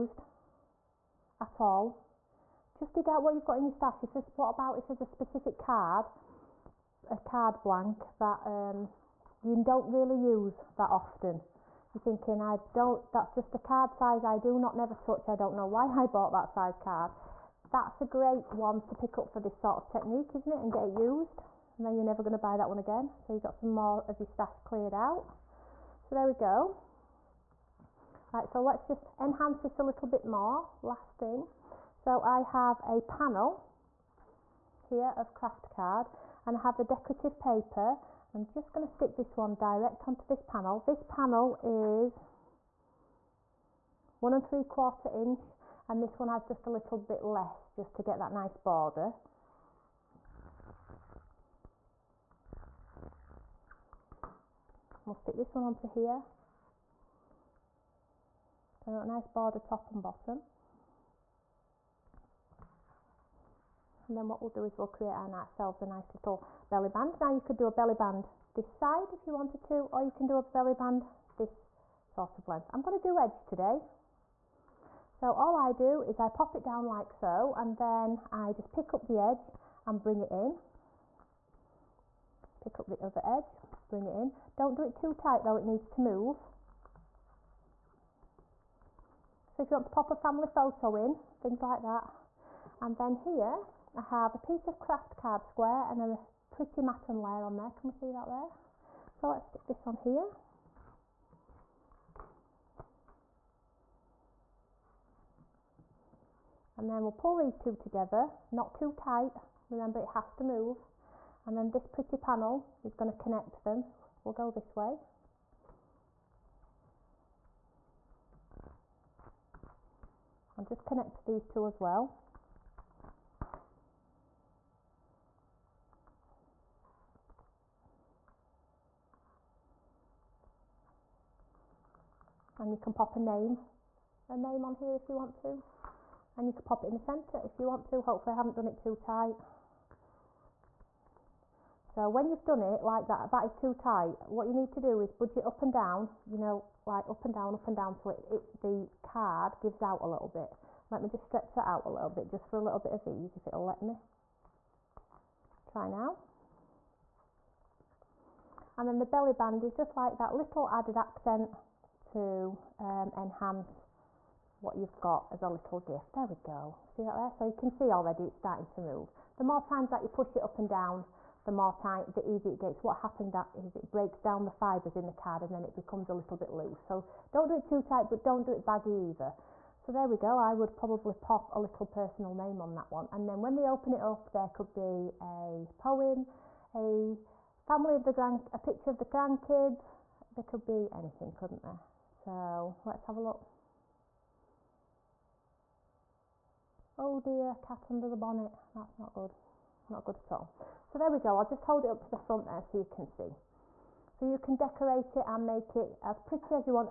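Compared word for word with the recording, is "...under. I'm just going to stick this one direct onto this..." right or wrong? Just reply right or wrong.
wrong.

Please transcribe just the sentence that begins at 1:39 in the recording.
So let's stick this on here.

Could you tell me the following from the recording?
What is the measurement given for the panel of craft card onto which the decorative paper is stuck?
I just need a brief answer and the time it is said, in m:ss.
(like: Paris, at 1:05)
1 3/4 inch, at 0:44.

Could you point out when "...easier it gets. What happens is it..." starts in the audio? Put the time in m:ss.
2:52.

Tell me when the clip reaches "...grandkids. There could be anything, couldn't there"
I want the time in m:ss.
3:09.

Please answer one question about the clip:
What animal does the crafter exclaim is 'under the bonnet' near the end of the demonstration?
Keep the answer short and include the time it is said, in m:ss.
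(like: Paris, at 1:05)
cat, at 3:17.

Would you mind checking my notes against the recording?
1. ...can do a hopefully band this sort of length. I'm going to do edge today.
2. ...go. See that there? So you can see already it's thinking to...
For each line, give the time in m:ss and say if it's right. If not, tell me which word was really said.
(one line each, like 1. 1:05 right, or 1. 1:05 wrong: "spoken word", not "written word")
1. 1:10 wrong: "belly", not "hopefully"
2. 2:46 wrong: "starting", not "thinking".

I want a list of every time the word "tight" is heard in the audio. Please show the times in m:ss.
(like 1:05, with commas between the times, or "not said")
1:25, 1:48, 2:18, 2:23, 2:51, 2:57.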